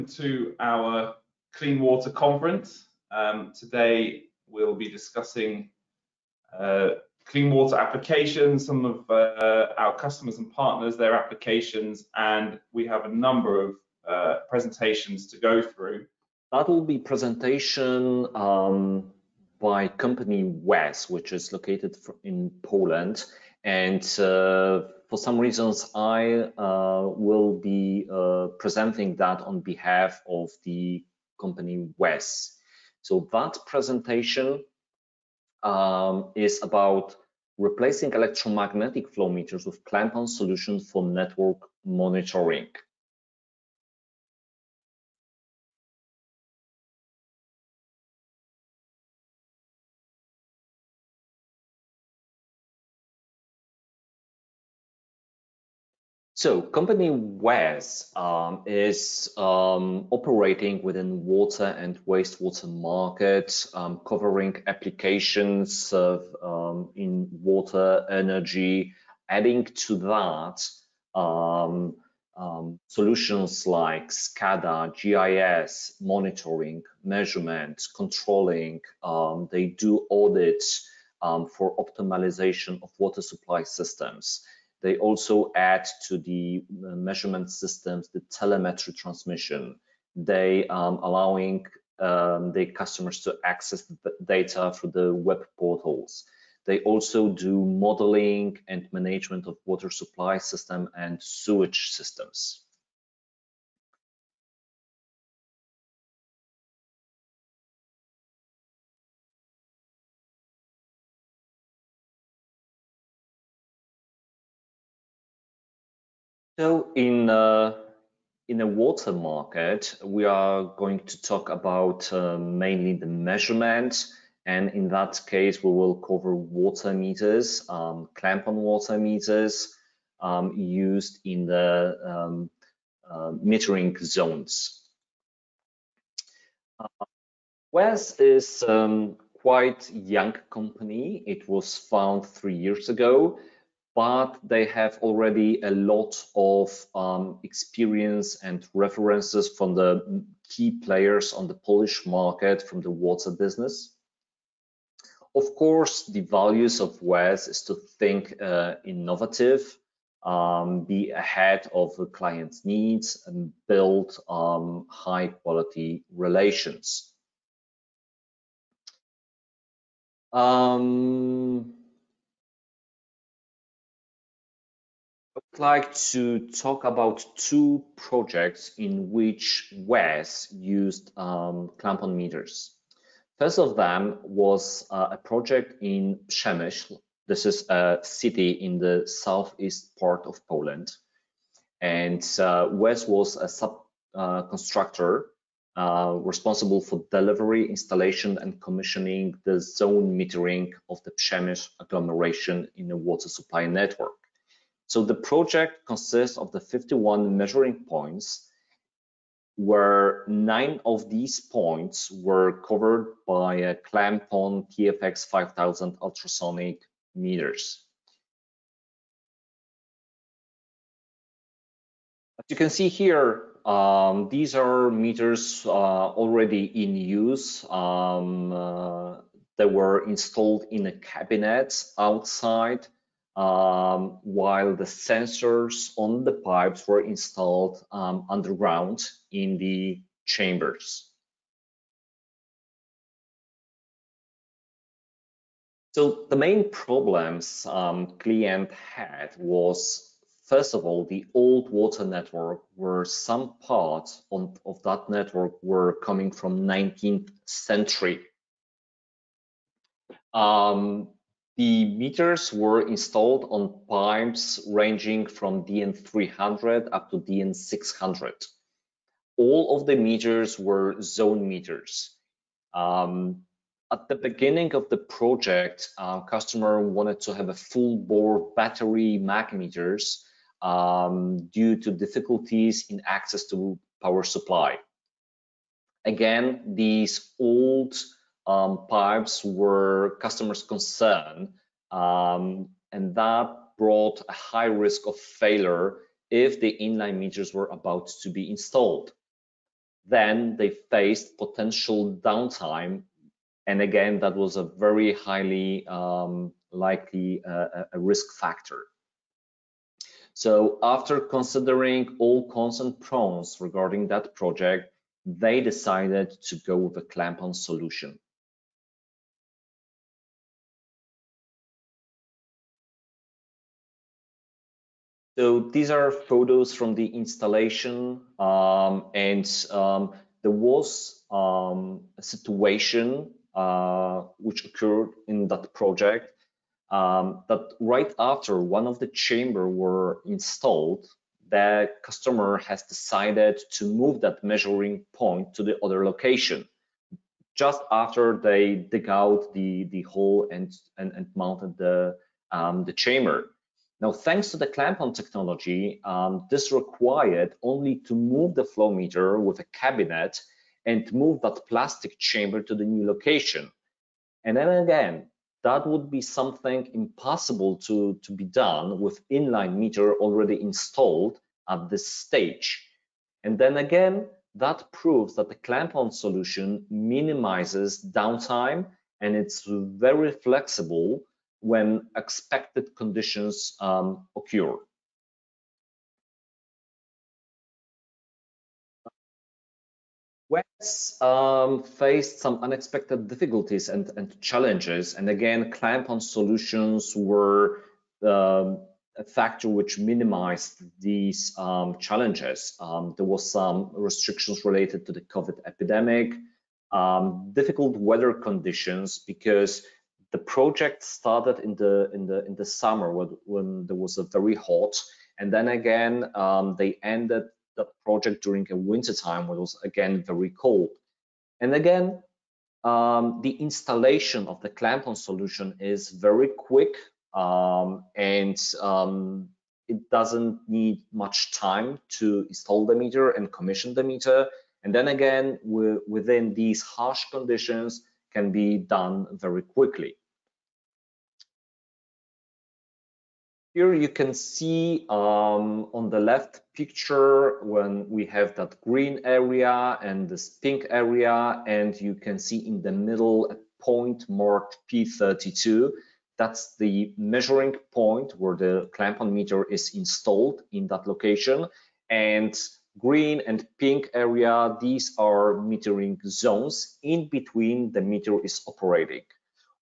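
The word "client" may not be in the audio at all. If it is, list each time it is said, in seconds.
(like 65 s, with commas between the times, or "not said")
162 s, 248 s.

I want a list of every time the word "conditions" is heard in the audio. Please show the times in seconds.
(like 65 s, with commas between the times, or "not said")
382 s, 408 s, 437 s.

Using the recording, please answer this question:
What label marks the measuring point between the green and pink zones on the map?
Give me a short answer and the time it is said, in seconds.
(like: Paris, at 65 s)
P32, at 454 s.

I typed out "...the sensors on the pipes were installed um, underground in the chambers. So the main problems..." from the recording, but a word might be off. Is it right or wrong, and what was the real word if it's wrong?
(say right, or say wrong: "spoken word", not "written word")
right.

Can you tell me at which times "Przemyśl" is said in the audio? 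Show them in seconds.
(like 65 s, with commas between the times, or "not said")
186 s, 201 s.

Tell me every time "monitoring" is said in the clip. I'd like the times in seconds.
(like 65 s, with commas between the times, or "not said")
41 s, 75 s.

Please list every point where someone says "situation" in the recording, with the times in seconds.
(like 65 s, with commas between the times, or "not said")
332 s.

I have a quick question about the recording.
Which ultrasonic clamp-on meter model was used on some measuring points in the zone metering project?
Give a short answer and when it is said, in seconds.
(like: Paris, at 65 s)
TFX 5000, at 214 s.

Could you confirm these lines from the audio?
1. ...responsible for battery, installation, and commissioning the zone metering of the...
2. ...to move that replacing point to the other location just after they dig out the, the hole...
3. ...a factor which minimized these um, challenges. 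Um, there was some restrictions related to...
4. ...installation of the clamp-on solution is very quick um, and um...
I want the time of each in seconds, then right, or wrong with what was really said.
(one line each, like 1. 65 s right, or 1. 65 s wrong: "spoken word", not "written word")
1. 196 s wrong: "delivery", not "battery"
2. 343 s wrong: "measuring", not "replacing"
3. 399 s right
4. 423 s right.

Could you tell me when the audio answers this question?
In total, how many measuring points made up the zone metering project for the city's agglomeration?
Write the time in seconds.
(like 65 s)
206 s.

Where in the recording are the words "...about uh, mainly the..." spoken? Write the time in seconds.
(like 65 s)
121 s.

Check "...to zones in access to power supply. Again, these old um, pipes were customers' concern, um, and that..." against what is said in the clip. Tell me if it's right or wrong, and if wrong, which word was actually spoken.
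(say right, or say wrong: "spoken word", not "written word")
wrong: "difficulties", not "zones".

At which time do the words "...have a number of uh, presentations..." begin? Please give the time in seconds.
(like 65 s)
12 s.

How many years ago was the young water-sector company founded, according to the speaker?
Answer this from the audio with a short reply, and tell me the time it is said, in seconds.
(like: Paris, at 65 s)
3, at 142 s.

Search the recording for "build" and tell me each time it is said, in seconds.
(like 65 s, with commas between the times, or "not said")
163 s.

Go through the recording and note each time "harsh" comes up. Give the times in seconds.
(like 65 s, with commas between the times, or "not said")
436 s.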